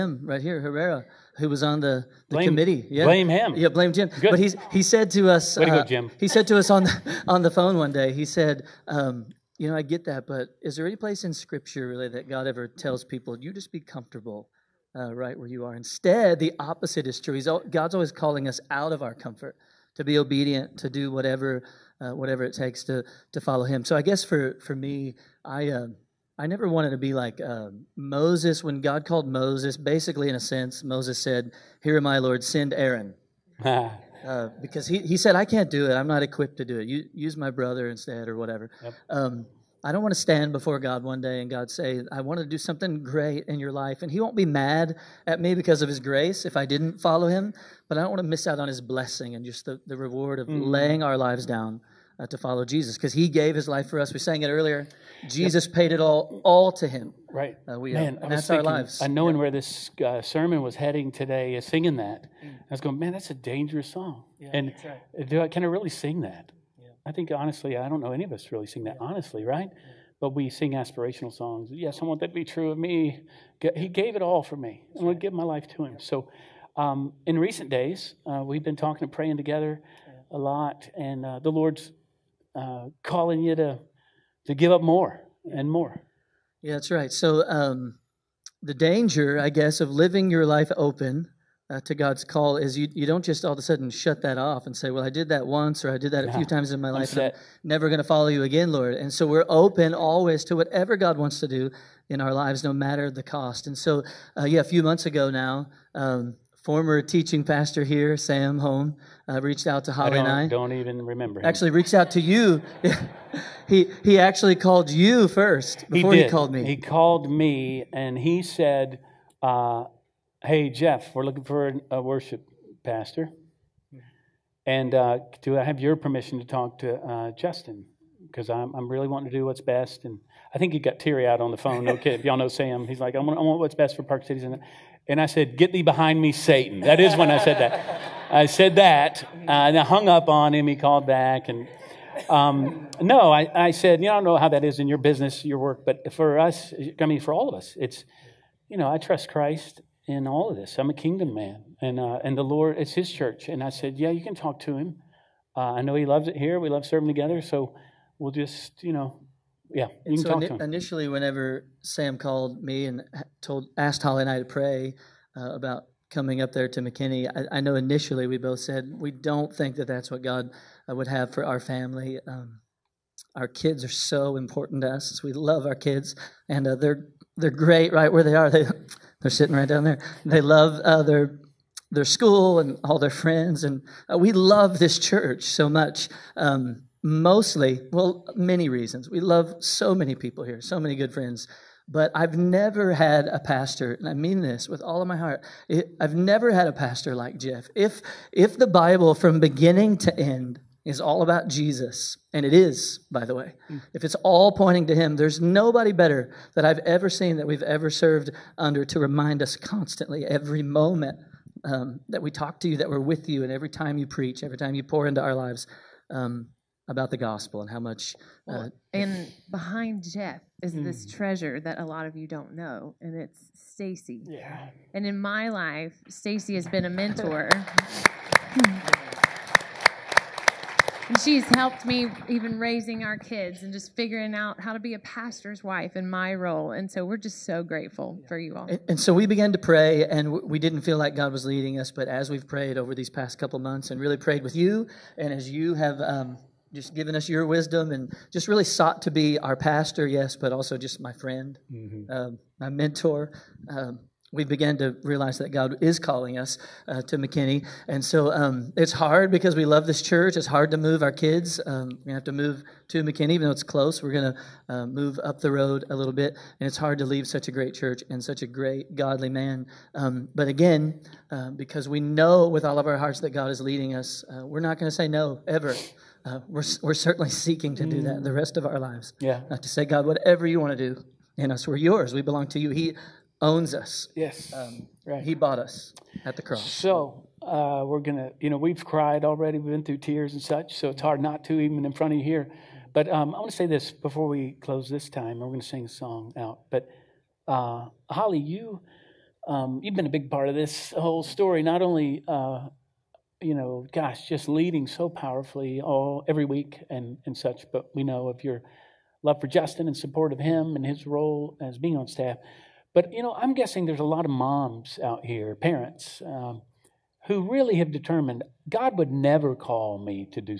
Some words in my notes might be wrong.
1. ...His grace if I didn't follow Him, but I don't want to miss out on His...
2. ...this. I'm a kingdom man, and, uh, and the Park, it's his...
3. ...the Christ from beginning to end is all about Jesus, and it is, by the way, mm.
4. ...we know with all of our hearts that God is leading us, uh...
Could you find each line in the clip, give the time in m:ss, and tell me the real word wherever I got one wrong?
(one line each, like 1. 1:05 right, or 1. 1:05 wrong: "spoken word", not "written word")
1. 0:45 right
2. 2:30 wrong: "Lord", not "Park"
3. 3:18 wrong: "Bible", not "Christ"
4. 4:31 right.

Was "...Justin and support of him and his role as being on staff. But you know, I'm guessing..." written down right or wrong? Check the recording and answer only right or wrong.
right.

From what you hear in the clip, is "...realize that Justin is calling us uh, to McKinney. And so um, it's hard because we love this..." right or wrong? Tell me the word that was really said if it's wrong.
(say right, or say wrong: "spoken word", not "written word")
wrong: "God", not "Justin".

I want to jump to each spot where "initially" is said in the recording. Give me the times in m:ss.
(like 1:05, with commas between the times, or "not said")
2:40, 2:47.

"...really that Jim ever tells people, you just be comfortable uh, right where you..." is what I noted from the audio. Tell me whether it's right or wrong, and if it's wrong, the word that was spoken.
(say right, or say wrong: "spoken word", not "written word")
wrong: "God", not "Jim".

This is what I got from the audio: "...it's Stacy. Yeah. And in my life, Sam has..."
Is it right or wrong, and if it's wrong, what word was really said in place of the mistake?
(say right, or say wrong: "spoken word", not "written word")
wrong: "Stacy", not "Sam".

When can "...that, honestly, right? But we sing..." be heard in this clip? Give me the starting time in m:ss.
1:08.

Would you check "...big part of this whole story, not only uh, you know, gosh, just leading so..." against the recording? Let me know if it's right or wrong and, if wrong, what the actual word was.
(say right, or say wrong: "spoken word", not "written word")
right.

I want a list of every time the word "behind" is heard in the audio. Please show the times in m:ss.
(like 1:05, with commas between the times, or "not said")
2:15, 3:39.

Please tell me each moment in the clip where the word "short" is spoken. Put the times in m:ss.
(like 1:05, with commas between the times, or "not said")
not said.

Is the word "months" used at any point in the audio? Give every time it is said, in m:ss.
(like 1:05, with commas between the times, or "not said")
1:44, 4:03.